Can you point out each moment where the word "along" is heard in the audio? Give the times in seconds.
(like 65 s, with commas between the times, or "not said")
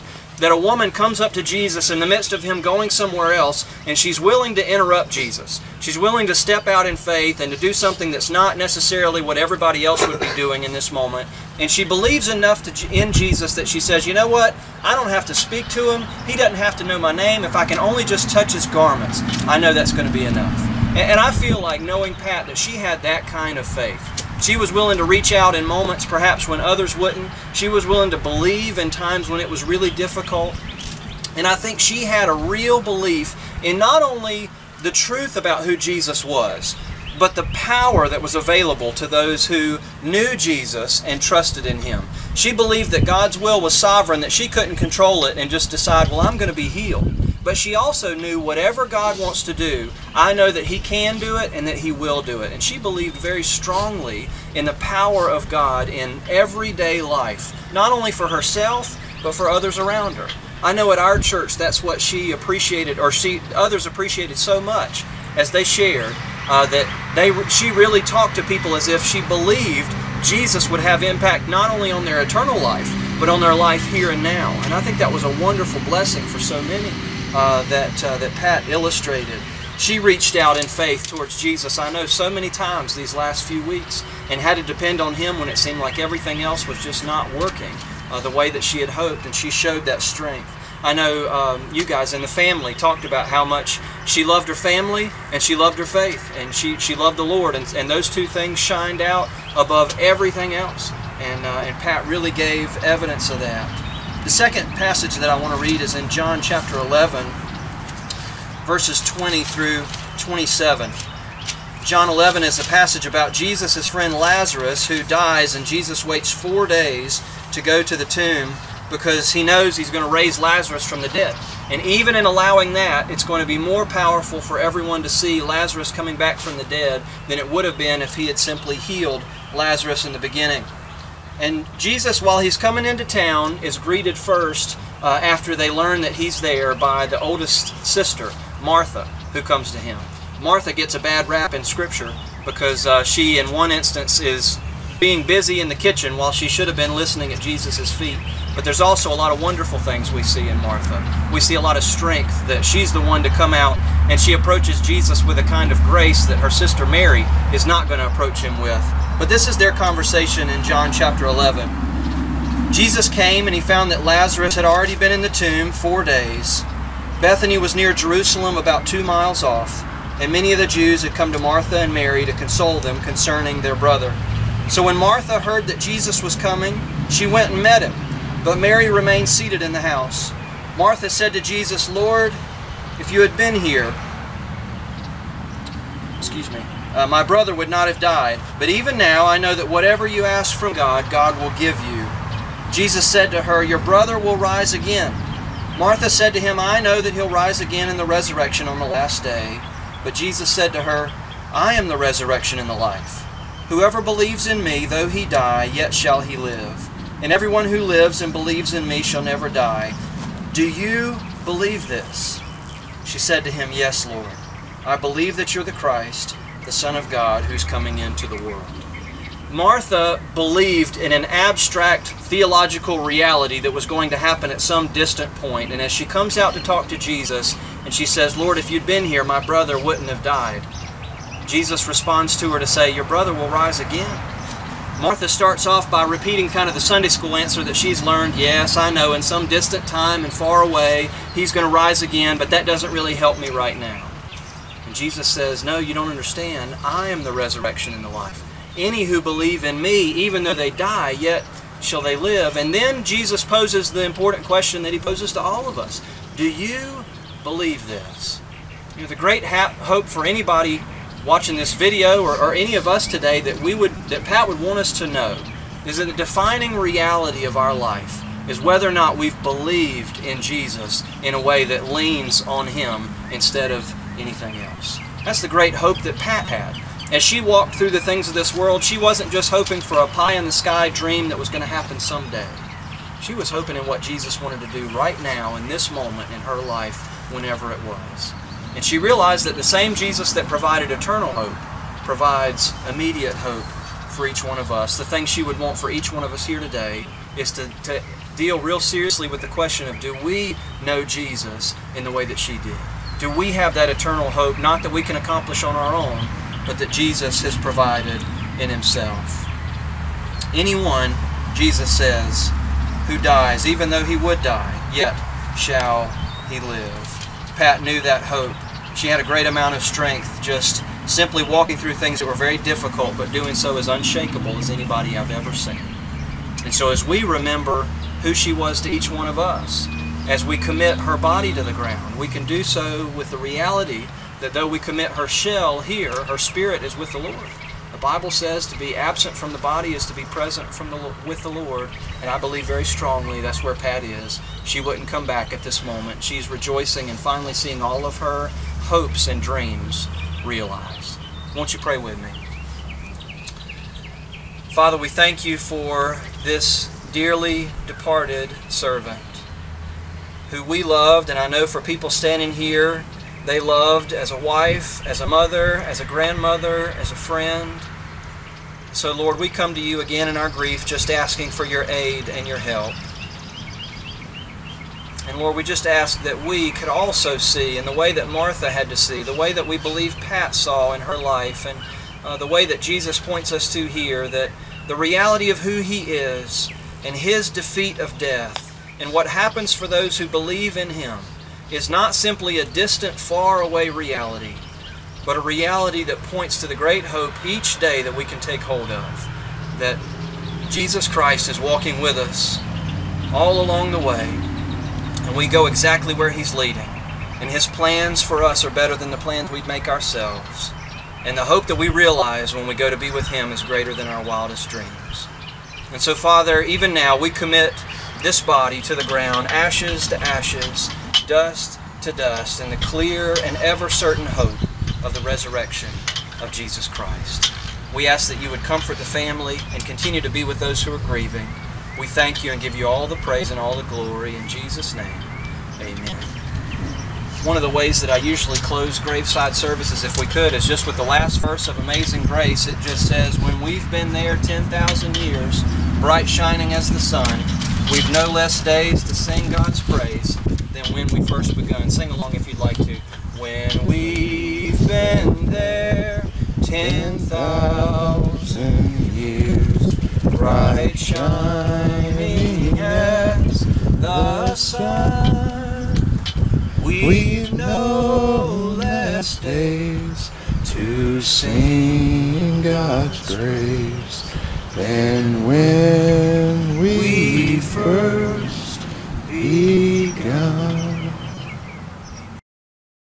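403 s, 452 s.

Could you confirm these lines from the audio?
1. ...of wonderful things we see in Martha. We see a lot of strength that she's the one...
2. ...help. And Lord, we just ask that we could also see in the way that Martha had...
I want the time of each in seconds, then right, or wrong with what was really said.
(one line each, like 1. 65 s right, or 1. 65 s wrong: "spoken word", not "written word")
1. 149 s right
2. 372 s right.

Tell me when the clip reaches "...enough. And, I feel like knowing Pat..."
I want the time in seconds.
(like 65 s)
20 s.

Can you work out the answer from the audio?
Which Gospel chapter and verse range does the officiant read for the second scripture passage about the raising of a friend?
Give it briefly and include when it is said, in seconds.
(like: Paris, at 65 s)
John 11:20-27, at 106 s.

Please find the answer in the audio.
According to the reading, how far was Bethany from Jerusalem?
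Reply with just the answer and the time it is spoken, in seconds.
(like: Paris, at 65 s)
About 2 miles, at 168 s.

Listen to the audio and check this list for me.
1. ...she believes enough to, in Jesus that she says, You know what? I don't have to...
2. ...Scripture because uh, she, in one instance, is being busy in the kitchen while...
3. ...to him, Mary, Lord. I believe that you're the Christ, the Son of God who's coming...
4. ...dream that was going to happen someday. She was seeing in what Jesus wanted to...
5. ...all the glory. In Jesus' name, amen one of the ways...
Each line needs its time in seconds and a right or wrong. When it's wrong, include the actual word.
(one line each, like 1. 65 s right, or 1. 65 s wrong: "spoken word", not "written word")
1. 11 s right
2. 141 s right
3. 213 s wrong: "Yes", not "Mary"
4. 280 s wrong: "hoping", not "seeing"
5. 433 s right.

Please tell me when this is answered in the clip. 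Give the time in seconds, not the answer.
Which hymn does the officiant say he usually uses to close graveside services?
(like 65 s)
441 s.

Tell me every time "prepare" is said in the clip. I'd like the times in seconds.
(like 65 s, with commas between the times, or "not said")
not said.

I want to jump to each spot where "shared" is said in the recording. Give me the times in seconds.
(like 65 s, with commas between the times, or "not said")
65 s.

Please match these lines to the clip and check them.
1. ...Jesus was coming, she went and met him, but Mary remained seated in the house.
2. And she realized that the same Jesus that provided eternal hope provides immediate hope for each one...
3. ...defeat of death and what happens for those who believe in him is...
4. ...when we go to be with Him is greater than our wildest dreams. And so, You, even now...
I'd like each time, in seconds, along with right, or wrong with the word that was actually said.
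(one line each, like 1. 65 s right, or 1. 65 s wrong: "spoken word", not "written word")
1. 175 s right
2. 288 s right
3. 387 s right
4. 412 s wrong: "Father", not "You".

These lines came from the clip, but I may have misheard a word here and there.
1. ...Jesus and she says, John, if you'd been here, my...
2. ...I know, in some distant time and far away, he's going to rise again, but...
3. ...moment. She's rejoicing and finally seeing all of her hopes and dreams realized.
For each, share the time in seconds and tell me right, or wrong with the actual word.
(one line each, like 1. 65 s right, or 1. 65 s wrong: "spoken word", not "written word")
1. 226 s wrong: "Lord", not "John"
2. 238 s right
3. 345 s right.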